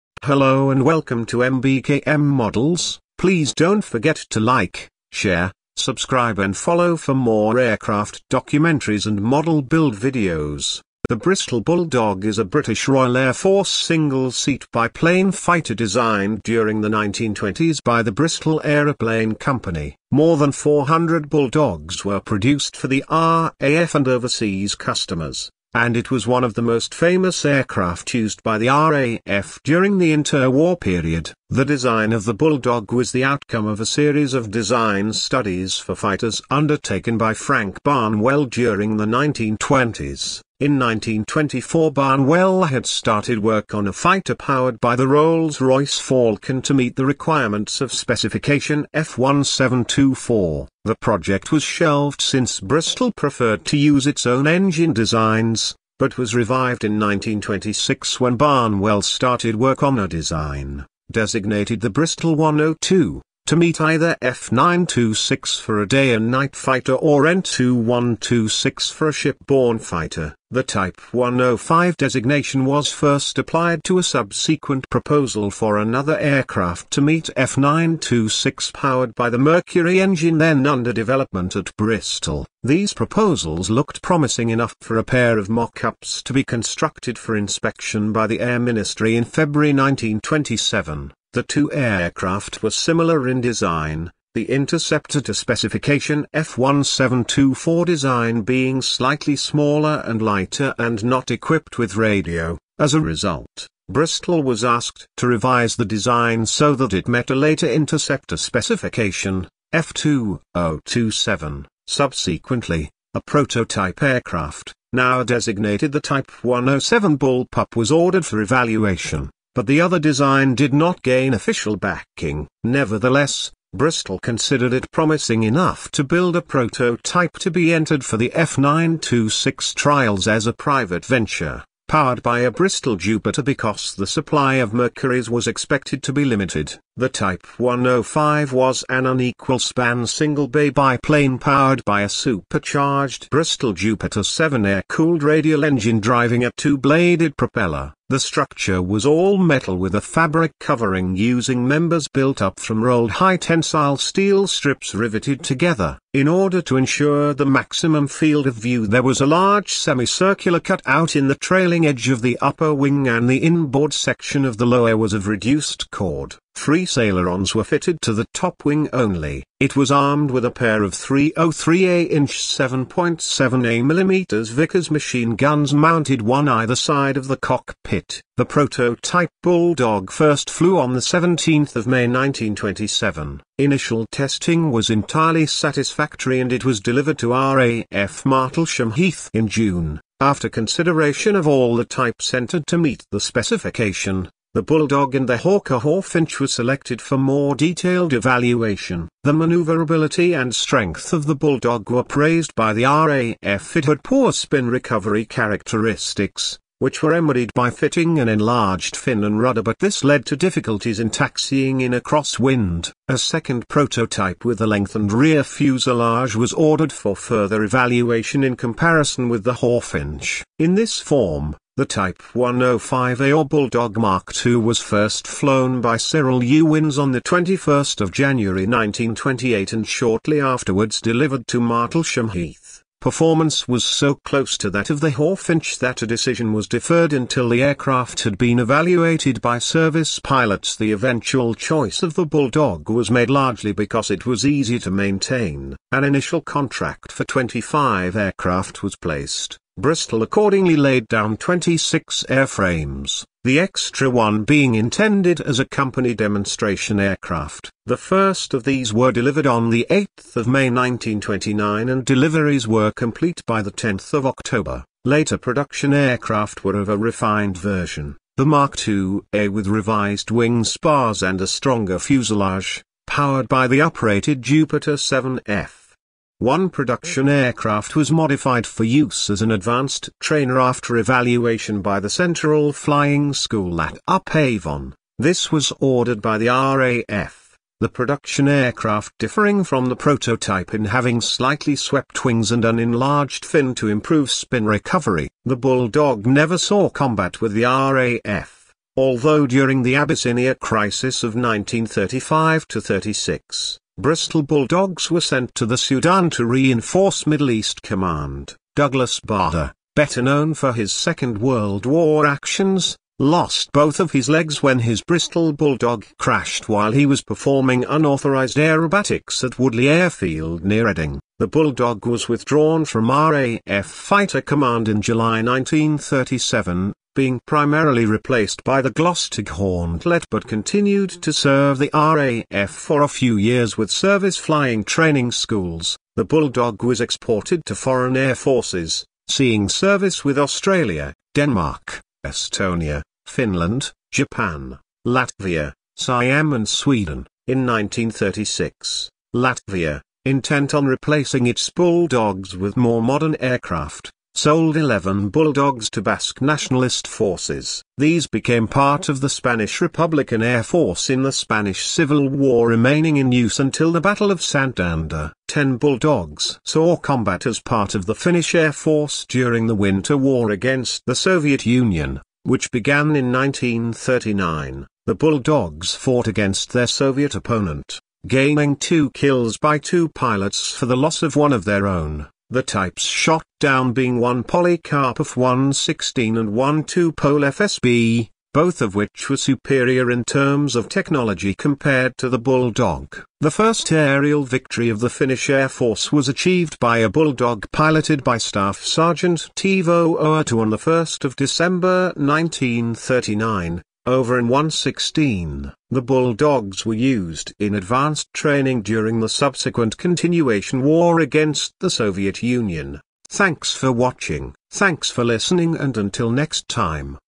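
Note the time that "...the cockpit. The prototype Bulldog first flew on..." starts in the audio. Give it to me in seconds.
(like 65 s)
177 s.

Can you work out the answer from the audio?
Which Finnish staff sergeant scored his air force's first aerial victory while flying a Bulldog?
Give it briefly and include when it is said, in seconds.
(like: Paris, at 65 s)
Toivo Uuttu, at 399 s.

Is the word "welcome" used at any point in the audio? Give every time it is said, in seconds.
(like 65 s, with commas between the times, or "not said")
0 s.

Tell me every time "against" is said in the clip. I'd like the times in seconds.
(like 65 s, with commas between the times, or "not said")
370 s, 376 s, 411 s.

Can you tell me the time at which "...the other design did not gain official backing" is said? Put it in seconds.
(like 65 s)
119 s.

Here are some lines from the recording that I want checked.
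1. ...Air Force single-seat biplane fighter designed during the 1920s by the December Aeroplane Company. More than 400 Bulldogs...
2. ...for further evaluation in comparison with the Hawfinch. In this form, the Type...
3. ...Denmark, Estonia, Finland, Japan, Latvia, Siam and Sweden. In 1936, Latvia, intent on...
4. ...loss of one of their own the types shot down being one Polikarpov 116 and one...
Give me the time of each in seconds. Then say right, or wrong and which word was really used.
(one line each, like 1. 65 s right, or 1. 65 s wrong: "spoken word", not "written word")
1. 13 s wrong: "Bristol", not "December"
2. 216 s right
3. 341 s right
4. 380 s right.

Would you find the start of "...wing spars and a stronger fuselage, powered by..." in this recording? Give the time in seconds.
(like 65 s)
270 s.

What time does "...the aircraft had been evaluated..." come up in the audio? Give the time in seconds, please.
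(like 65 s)
237 s.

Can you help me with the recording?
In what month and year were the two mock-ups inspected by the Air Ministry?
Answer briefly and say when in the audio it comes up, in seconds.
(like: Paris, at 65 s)
February 1927, at 89 s.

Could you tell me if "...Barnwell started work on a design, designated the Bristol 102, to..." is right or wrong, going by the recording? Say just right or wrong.
right.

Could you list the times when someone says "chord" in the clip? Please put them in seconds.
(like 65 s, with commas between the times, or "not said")
165 s.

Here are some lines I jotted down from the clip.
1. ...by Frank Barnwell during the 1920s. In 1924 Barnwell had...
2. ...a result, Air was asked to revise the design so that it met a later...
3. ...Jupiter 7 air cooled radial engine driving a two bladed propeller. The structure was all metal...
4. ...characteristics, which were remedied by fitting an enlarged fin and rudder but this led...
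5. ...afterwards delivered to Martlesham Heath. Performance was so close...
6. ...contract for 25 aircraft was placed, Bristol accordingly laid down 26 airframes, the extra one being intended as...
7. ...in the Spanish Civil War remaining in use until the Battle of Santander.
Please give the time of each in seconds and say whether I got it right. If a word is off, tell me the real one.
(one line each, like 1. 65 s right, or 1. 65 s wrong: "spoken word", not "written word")
1. 37 s right
2. 102 s wrong: "Bristol", not "Air"
3. 143 s right
4. 205 s right
5. 230 s right
6. 246 s right
7. 361 s right.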